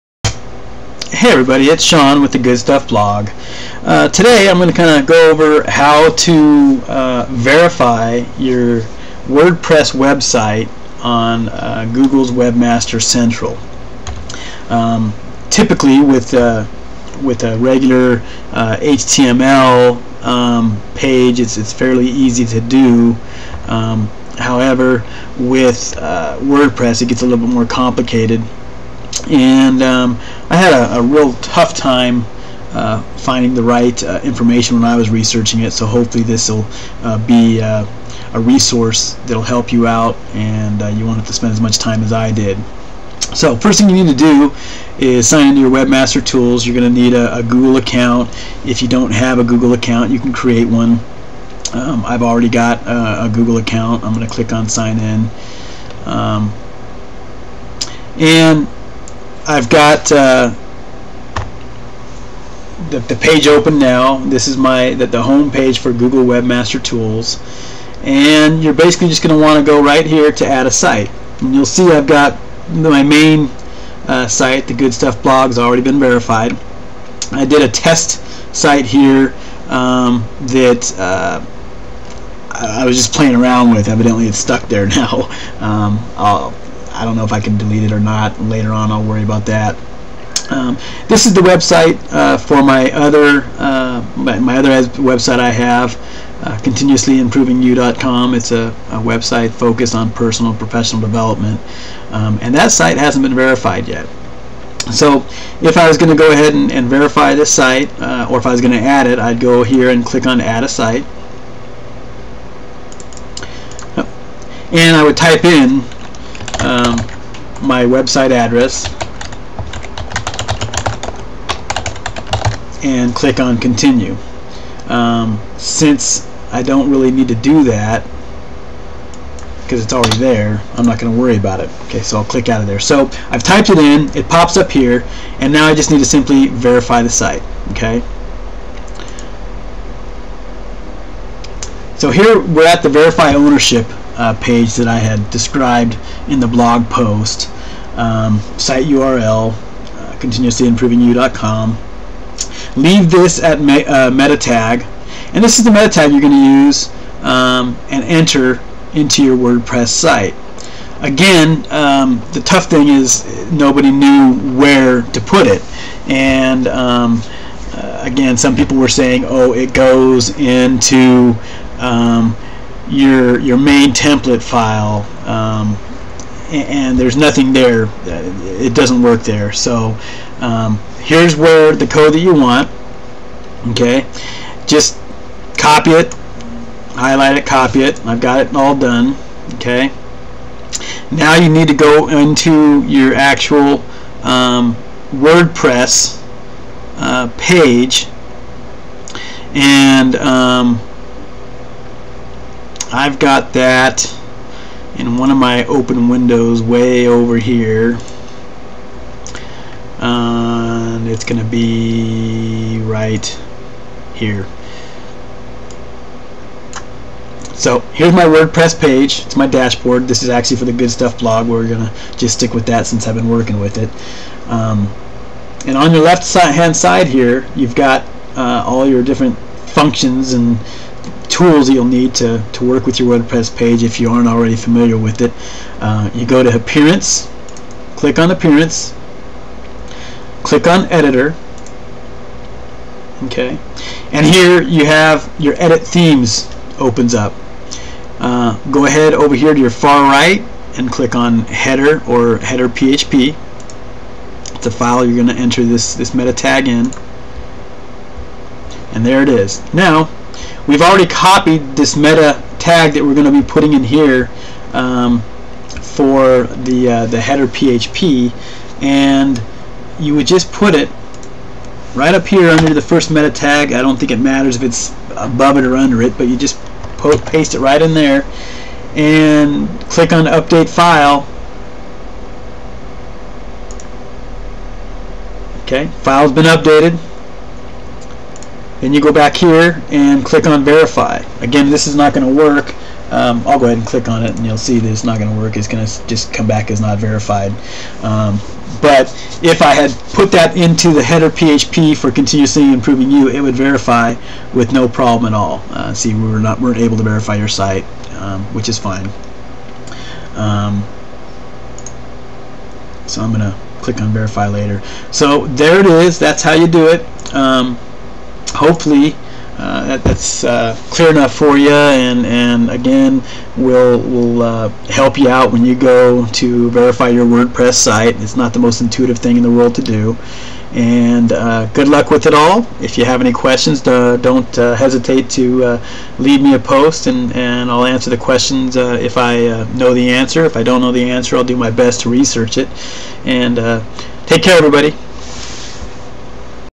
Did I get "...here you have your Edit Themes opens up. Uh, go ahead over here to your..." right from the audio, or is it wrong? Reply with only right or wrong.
right.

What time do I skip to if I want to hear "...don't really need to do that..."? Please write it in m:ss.
2:06.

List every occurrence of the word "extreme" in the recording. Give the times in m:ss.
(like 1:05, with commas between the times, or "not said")
not said.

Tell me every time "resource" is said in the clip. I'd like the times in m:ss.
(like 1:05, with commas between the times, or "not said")
0:38.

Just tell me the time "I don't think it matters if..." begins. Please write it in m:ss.
4:33.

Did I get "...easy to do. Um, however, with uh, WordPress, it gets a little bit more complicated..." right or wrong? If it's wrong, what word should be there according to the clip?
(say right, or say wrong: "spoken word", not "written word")
right.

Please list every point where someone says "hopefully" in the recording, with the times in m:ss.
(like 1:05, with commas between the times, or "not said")
0:35, 5:18.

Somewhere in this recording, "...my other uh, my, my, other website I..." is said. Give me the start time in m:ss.
1:32.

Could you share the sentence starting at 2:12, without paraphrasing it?
So I've typed it in, it pops up here, and now I just need to simply verify the site.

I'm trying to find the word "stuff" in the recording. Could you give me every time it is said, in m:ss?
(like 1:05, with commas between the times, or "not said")
0:02, 1:14, 3:40.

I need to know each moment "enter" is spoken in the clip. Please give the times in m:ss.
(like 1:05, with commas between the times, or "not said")
2:38, 4:15.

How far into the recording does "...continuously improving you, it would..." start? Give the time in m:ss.
5:02.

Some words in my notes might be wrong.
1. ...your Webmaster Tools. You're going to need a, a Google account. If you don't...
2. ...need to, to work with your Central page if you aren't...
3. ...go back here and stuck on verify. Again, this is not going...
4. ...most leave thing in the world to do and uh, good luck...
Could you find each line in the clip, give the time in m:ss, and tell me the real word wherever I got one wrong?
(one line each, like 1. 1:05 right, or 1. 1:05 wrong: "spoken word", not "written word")
1. 0:45 right
2. 3:51 wrong: "WordPress", not "Central"
3. 4:48 wrong: "click", not "stuck"
4. 5:28 wrong: "intuitive", not "leave".